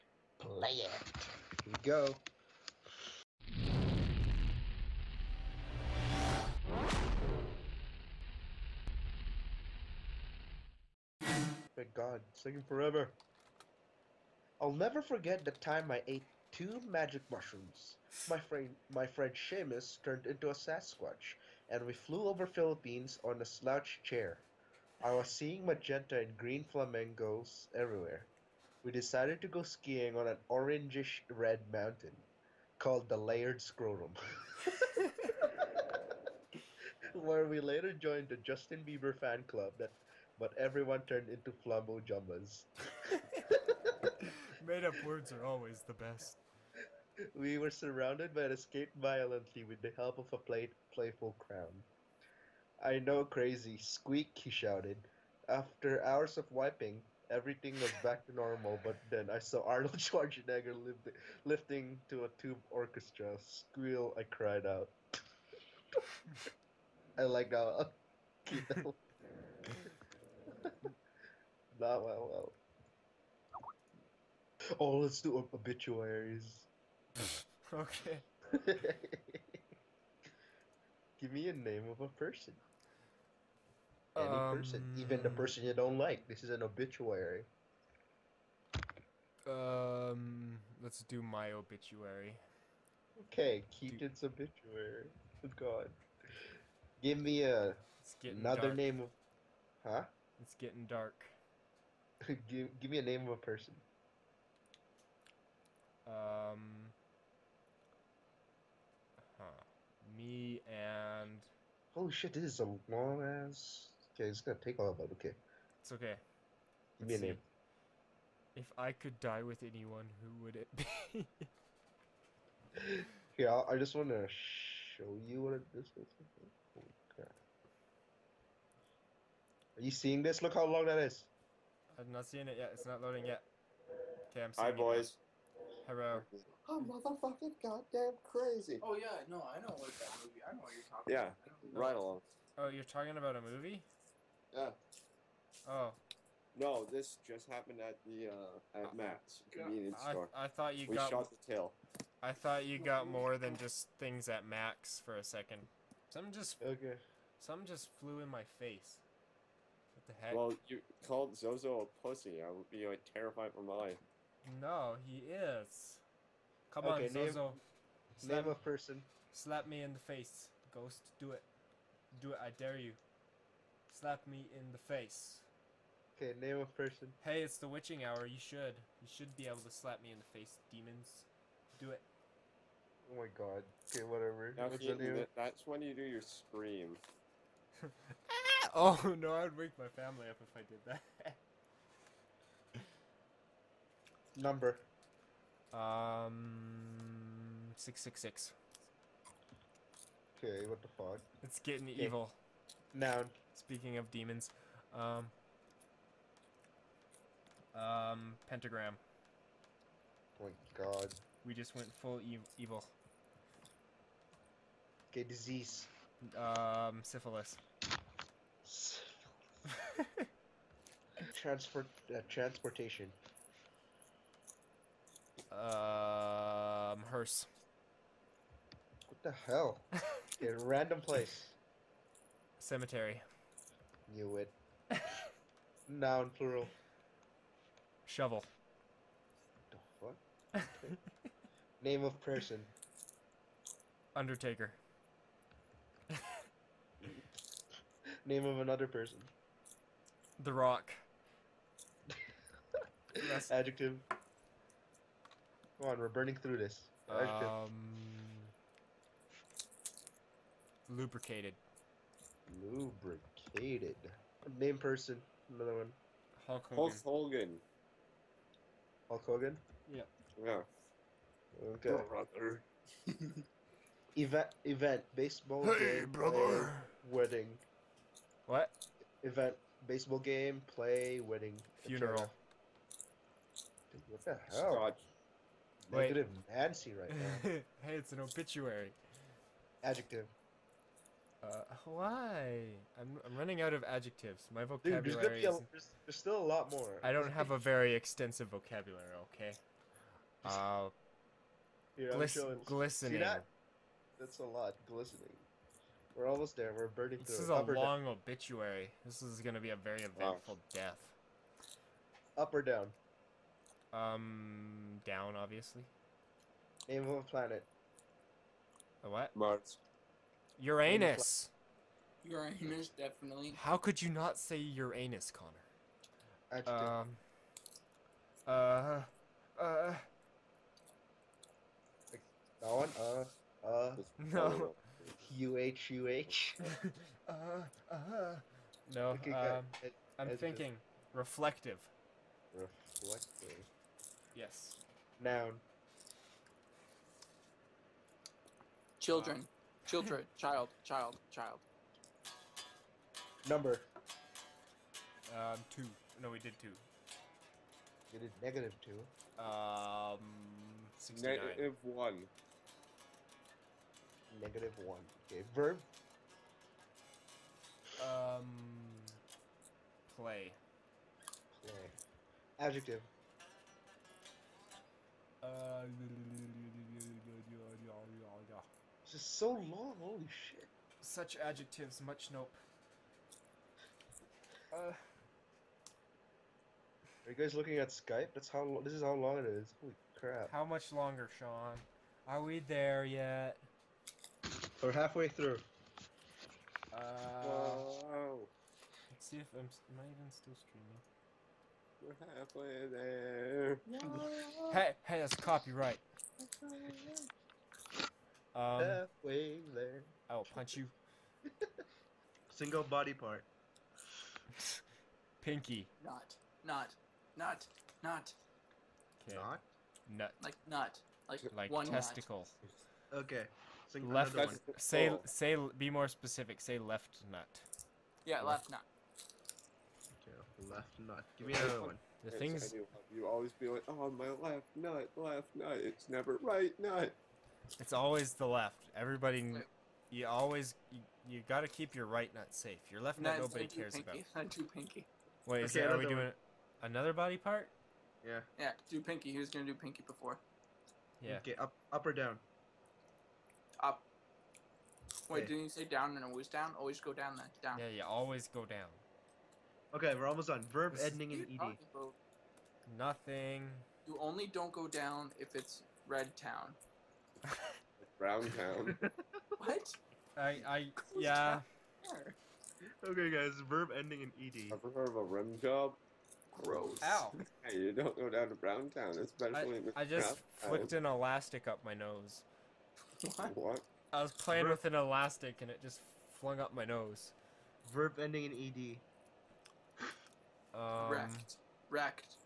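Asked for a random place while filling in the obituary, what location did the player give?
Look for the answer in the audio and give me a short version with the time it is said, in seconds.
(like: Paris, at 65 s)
Cemetery, at 232 s.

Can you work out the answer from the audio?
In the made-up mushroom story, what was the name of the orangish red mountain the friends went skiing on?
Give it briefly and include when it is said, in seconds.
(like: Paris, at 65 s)
Layered Scrotum, at 33 s.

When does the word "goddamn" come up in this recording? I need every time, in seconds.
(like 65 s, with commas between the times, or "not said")
137 s.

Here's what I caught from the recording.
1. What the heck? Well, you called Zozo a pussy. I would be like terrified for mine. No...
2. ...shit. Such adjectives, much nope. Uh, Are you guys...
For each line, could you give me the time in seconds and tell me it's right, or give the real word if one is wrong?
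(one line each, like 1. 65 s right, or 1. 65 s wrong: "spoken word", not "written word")
1. 159 s right
2. 380 s right.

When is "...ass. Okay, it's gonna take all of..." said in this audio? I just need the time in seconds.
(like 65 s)
113 s.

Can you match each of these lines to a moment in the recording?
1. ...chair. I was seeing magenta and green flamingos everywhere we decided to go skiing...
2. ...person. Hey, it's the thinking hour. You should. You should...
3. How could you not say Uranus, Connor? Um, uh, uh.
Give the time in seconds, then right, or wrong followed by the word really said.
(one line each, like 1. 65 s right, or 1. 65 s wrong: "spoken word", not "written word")
1. 24 s right
2. 176 s wrong: "witching", not "thinking"
3. 323 s right.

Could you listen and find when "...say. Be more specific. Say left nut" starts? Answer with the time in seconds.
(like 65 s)
425 s.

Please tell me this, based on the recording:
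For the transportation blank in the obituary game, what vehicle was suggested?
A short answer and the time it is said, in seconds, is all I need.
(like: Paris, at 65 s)
hearse, at 227 s.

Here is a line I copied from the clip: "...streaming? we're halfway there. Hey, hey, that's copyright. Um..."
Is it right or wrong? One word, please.
right.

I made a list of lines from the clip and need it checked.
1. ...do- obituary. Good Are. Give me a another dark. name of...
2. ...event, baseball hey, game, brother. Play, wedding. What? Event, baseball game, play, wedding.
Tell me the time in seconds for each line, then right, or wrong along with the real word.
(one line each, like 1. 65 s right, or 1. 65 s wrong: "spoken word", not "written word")
1. 94 s wrong: "God", not "Are"
2. 274 s right.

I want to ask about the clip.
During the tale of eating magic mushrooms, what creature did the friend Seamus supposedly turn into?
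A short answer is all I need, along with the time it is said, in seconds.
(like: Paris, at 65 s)
Sasquatch, at 20 s.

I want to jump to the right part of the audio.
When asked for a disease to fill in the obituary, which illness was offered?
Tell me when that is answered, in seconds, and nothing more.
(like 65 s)
217 s.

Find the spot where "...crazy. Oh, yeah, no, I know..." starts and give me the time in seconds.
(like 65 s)
138 s.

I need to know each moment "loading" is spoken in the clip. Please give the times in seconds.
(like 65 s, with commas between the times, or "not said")
133 s.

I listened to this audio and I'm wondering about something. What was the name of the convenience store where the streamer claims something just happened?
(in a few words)
Matt's.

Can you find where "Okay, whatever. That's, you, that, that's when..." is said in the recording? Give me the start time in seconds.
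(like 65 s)
183 s.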